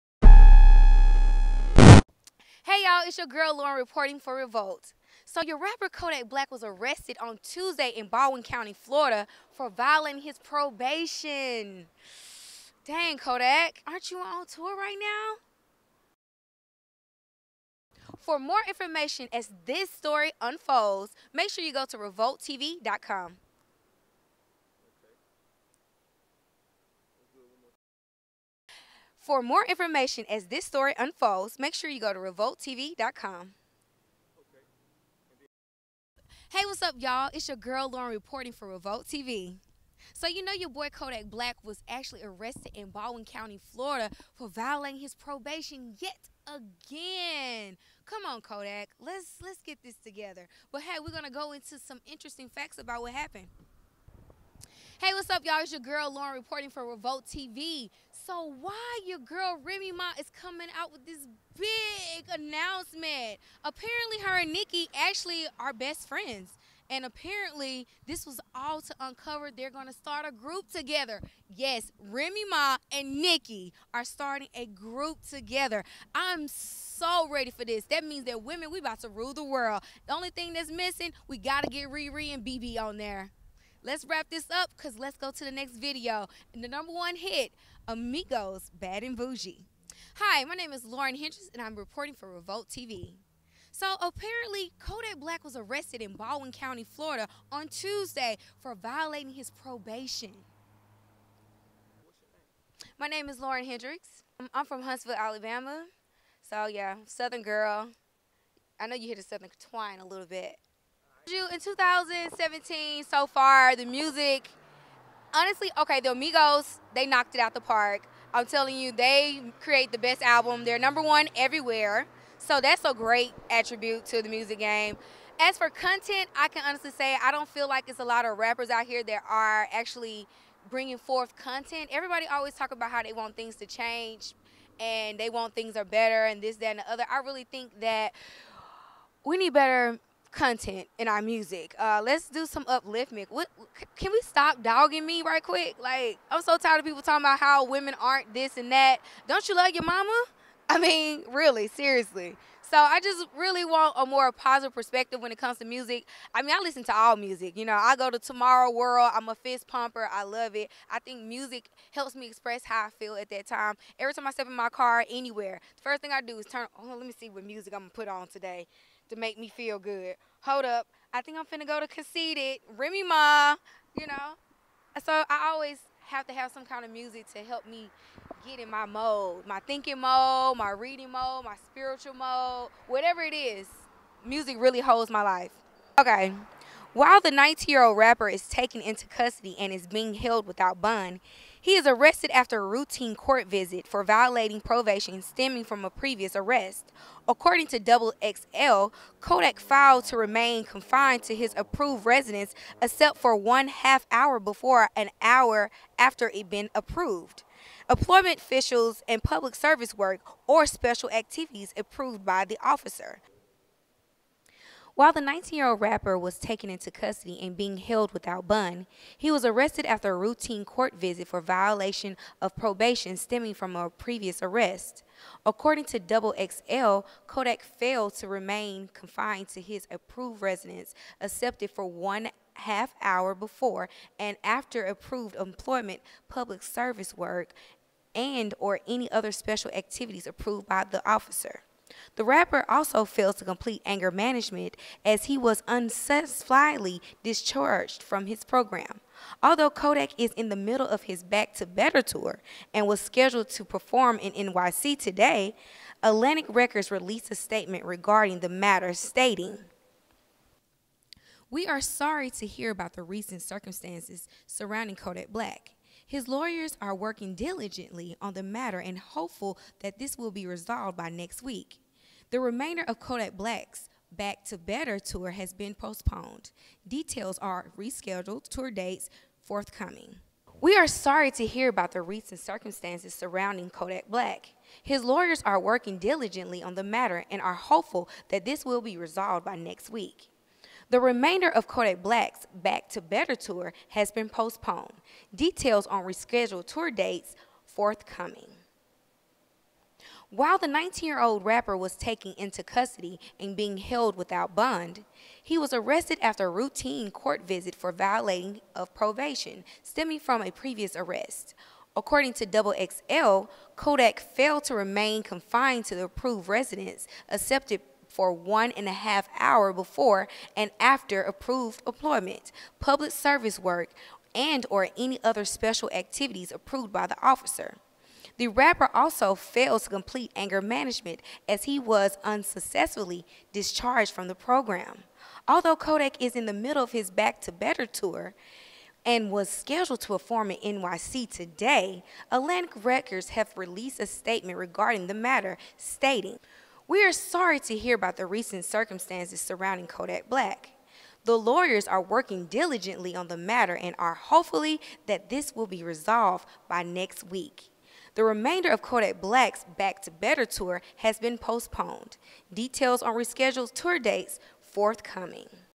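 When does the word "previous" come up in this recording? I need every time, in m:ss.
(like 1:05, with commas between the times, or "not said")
3:15, 3:43, 5:10.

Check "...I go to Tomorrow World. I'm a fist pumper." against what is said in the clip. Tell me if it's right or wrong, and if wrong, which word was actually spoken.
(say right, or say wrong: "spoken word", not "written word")
right.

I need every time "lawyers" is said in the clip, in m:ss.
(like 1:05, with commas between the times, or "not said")
4:26, 4:45, 5:51.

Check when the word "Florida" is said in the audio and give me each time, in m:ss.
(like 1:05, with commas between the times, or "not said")
0:08, 0:43, 1:36.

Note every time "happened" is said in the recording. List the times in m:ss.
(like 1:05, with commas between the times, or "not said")
0:53.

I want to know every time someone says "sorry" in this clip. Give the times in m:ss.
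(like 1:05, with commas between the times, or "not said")
4:21, 4:40, 5:47.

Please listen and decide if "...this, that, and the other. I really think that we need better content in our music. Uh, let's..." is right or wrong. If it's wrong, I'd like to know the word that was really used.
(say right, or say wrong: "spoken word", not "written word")
right.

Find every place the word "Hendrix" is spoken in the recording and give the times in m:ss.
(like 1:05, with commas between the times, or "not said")
1:31, 1:43.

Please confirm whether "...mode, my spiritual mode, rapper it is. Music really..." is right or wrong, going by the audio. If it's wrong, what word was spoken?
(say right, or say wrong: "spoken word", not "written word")
wrong: "whatever", not "rapper".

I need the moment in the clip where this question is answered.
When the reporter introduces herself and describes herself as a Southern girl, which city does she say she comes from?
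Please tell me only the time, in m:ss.
1:44.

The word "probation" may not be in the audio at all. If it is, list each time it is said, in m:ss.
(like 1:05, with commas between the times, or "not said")
0:10, 0:45, 1:39, 3:14, 3:42, 5:08.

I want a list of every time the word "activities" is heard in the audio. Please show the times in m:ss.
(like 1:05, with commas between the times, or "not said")
3:31, 3:59, 5:25.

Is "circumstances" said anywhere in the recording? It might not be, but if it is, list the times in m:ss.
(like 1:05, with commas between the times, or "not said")
4:23, 4:42, 5:48.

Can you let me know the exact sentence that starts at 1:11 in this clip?
Yes, Remy Ma and Nicki are starting a group together.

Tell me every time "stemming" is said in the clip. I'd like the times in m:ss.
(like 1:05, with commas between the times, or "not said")
3:15, 3:43, 5:09.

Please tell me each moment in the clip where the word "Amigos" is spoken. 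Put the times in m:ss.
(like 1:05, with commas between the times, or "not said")
1:27, 1:56.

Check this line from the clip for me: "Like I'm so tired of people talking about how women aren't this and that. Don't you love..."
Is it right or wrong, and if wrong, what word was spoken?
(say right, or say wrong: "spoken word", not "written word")
right.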